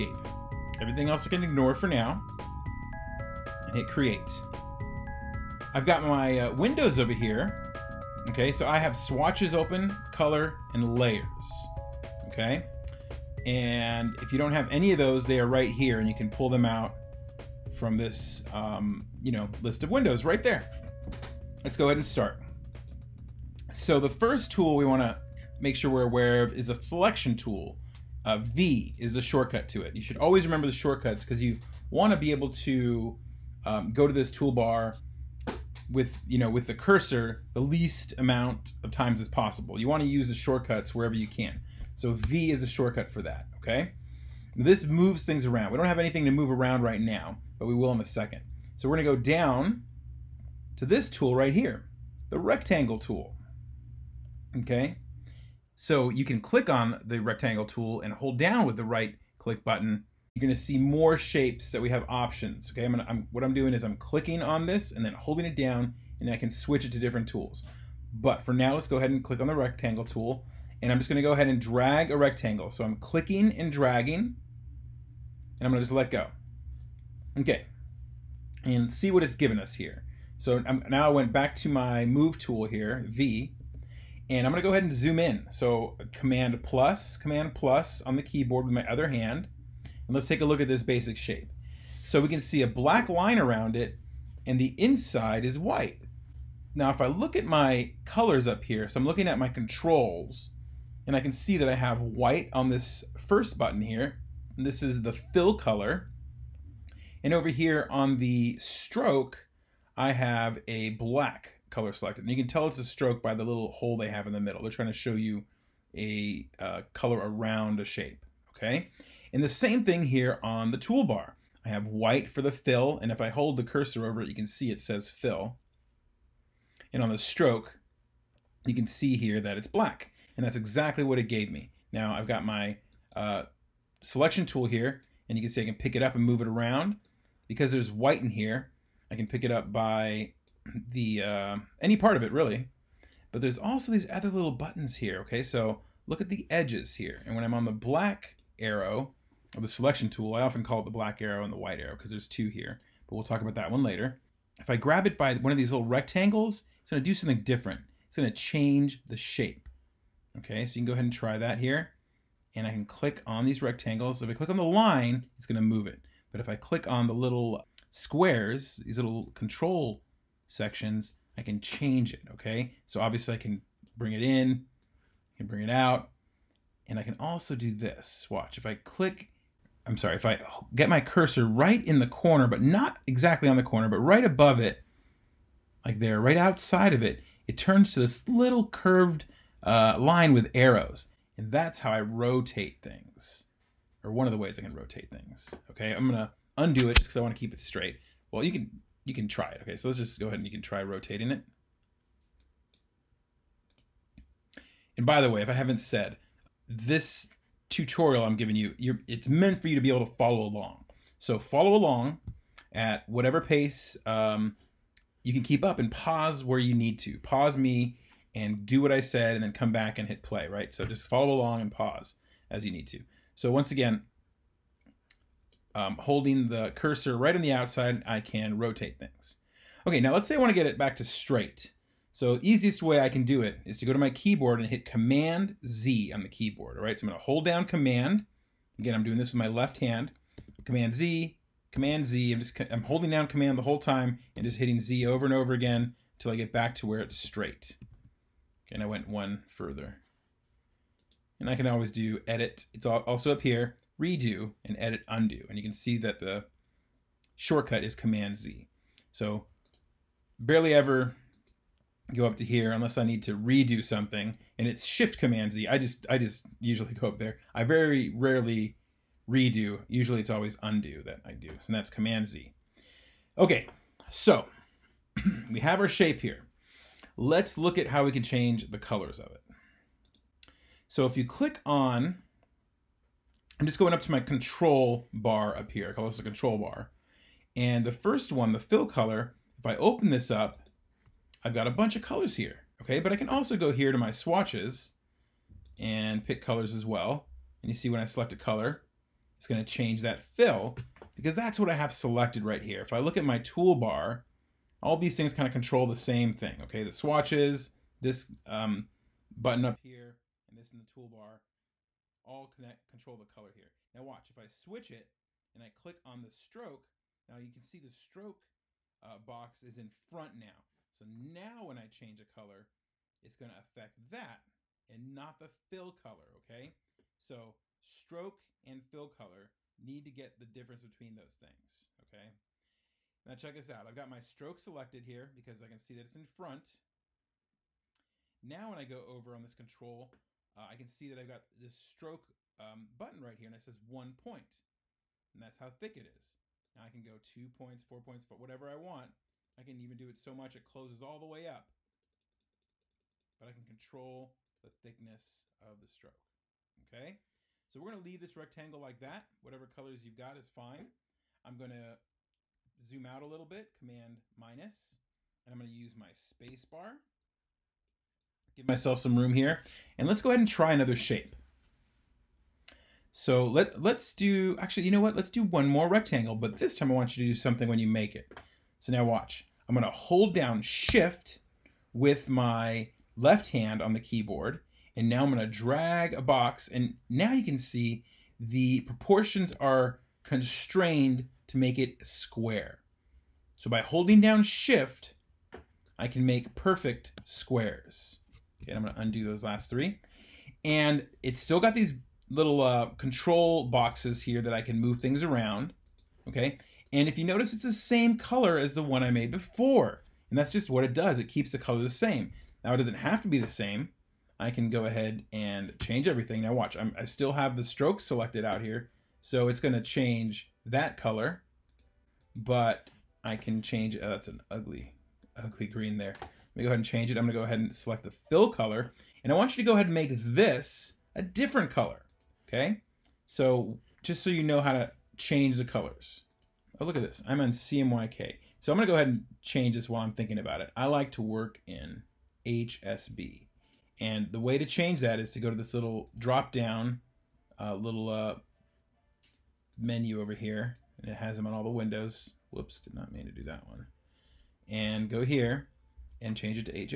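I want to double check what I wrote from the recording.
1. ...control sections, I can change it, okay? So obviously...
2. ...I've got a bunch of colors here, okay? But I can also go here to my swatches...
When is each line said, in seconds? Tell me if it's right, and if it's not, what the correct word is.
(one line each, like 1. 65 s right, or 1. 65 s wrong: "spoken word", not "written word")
1. 169 s right
2. 291 s right.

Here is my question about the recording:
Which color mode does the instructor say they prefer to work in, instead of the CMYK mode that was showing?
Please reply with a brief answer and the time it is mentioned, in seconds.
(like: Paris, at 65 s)
HSB, at 442 s.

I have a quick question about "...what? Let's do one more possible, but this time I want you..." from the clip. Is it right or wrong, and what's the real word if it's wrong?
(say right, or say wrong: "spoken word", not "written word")
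wrong: "rectangle", not "possible".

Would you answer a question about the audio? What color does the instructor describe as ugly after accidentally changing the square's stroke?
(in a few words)
green.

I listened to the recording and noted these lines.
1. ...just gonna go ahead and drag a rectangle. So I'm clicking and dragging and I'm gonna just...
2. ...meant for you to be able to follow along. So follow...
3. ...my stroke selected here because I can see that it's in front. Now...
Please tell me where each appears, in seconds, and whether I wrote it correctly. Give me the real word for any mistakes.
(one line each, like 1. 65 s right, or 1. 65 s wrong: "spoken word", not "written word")
1. 70 s right
2. 209 s right
3. 334 s right.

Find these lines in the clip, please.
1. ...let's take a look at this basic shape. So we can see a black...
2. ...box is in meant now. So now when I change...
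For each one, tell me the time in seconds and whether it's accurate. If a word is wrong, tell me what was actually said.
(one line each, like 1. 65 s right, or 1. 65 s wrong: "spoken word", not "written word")
1. 90 s right
2. 319 s wrong: "front", not "meant".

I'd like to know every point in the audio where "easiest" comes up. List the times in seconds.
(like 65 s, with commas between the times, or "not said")
232 s.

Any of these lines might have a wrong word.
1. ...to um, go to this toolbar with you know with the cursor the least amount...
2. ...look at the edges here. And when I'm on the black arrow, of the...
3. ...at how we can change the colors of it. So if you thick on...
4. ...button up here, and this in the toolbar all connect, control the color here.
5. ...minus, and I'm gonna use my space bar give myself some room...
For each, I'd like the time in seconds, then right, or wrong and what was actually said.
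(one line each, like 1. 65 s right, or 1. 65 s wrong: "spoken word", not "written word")
1. 32 s right
2. 146 s right
3. 277 s wrong: "click", not "thick"
4. 309 s right
5. 364 s right.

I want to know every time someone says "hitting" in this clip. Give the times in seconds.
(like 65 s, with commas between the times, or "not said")
244 s.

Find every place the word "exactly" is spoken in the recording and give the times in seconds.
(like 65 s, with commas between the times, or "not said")
130 s, 183 s.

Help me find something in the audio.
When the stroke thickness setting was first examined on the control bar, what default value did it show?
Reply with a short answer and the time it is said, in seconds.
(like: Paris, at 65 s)
1 point, at 343 s.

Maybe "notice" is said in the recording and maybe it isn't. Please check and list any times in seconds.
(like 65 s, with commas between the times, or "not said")
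407 s.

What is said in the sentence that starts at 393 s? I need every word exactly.
So by holding down shift, I can make perfect squares.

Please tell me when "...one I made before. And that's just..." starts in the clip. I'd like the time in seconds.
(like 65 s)
408 s.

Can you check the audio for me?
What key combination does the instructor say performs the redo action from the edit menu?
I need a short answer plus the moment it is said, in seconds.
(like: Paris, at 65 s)
Shift Command Z, at 264 s.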